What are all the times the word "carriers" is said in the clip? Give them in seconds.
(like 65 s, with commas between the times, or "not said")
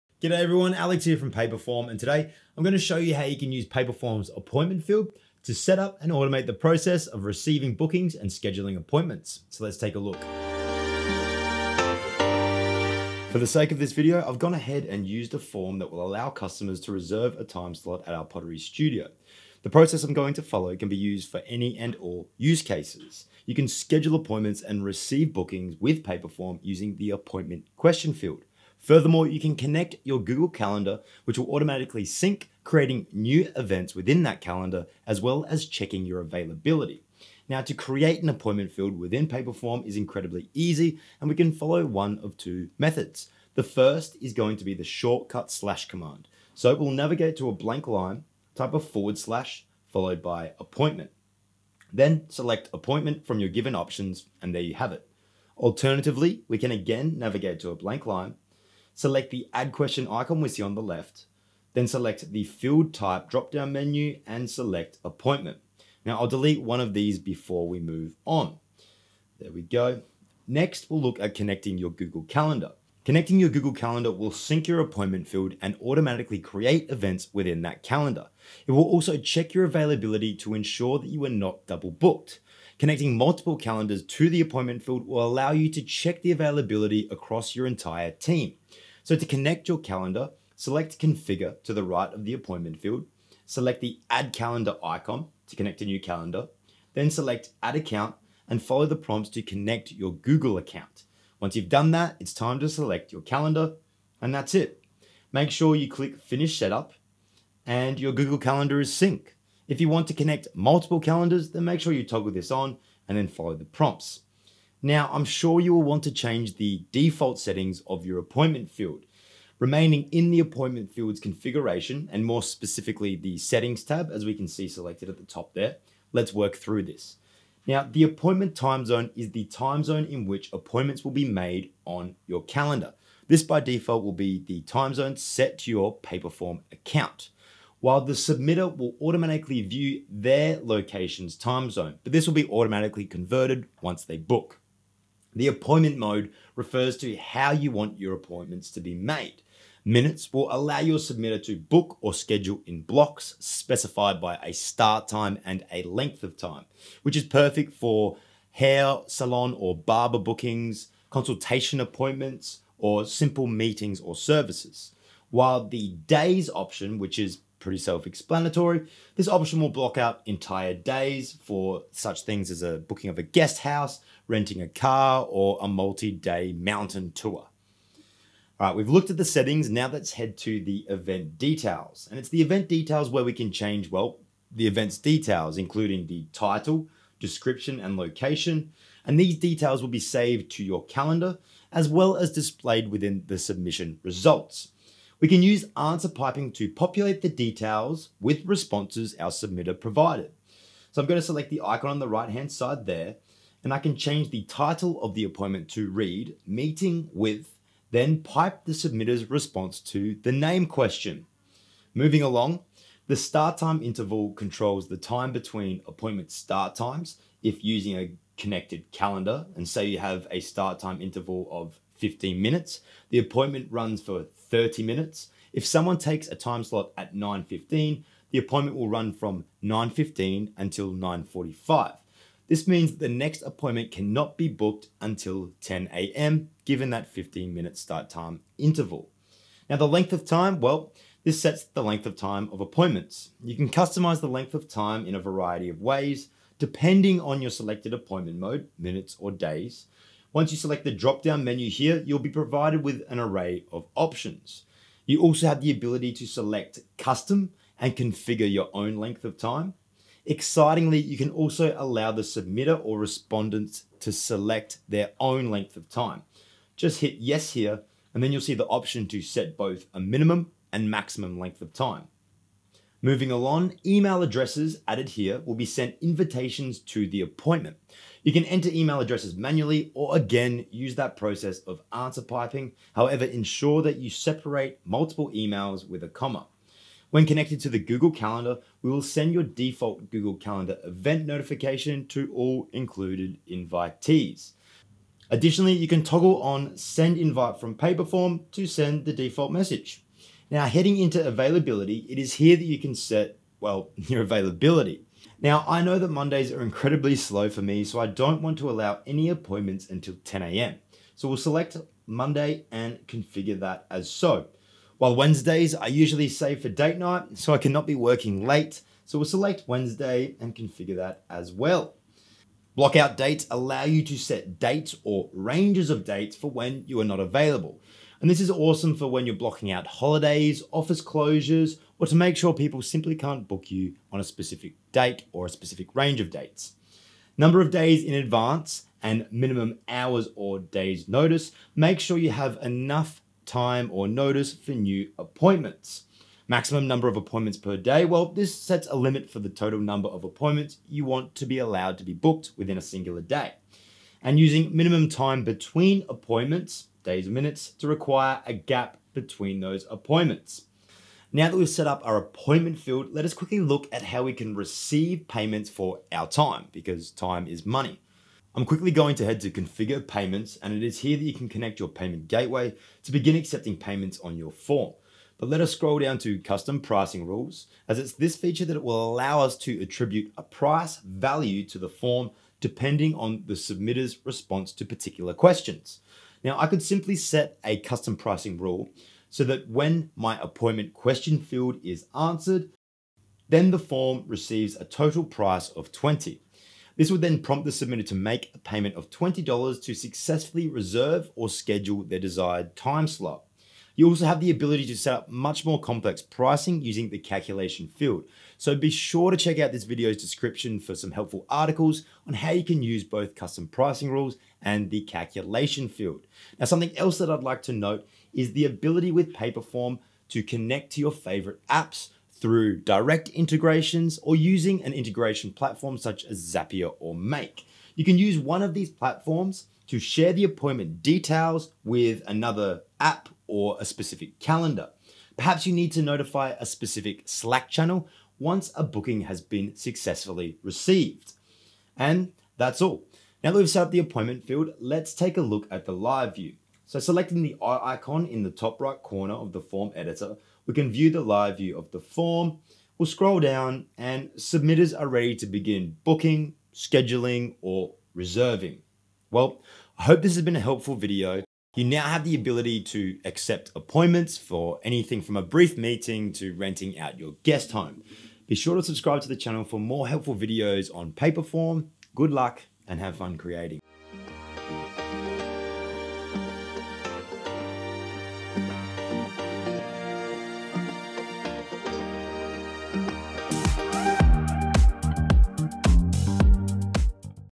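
not said.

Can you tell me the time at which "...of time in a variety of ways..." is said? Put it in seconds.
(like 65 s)
244 s.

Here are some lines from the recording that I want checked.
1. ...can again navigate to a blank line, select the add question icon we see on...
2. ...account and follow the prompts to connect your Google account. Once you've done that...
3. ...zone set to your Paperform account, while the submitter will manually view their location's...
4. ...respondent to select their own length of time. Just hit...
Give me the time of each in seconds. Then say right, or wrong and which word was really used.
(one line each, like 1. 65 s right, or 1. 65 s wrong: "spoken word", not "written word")
1. 56 s right
2. 97 s right
3. 134 s wrong: "automatically", not "manually"
4. 262 s right.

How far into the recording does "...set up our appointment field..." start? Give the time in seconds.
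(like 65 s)
361 s.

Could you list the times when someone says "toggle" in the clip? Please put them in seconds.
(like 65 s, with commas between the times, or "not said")
112 s, 296 s.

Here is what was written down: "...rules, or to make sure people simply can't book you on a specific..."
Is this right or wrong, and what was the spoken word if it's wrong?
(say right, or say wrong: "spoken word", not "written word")
wrong: "closures", not "rules".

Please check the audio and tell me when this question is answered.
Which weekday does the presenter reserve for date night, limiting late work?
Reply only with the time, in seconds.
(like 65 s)
315 s.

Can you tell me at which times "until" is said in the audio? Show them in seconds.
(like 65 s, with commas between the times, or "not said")
230 s, 234 s, 309 s.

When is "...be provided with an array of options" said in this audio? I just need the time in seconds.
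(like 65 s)
252 s.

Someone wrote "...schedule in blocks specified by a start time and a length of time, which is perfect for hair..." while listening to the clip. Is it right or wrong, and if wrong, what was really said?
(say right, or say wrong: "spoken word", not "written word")
right.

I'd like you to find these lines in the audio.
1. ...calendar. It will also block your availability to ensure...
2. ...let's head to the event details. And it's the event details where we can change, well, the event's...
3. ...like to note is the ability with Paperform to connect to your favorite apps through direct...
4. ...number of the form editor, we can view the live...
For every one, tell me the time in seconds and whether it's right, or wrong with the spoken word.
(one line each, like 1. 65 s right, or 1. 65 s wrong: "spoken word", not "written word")
1. 77 s wrong: "check", not "block"
2. 179 s right
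3. 417 s right
4. 449 s wrong: "corner", not "number".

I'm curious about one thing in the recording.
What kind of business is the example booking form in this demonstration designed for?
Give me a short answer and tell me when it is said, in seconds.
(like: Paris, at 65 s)
Pottery studio, at 18 s.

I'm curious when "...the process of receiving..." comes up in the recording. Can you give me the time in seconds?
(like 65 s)
6 s.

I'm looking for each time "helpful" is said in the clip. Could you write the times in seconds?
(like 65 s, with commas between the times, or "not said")
411 s, 460 s, 470 s.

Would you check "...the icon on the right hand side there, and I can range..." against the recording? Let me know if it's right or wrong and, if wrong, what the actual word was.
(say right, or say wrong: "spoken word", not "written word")
wrong: "change", not "range".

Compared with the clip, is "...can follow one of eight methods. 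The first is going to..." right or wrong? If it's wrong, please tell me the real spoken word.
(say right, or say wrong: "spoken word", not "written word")
wrong: "two", not "eight".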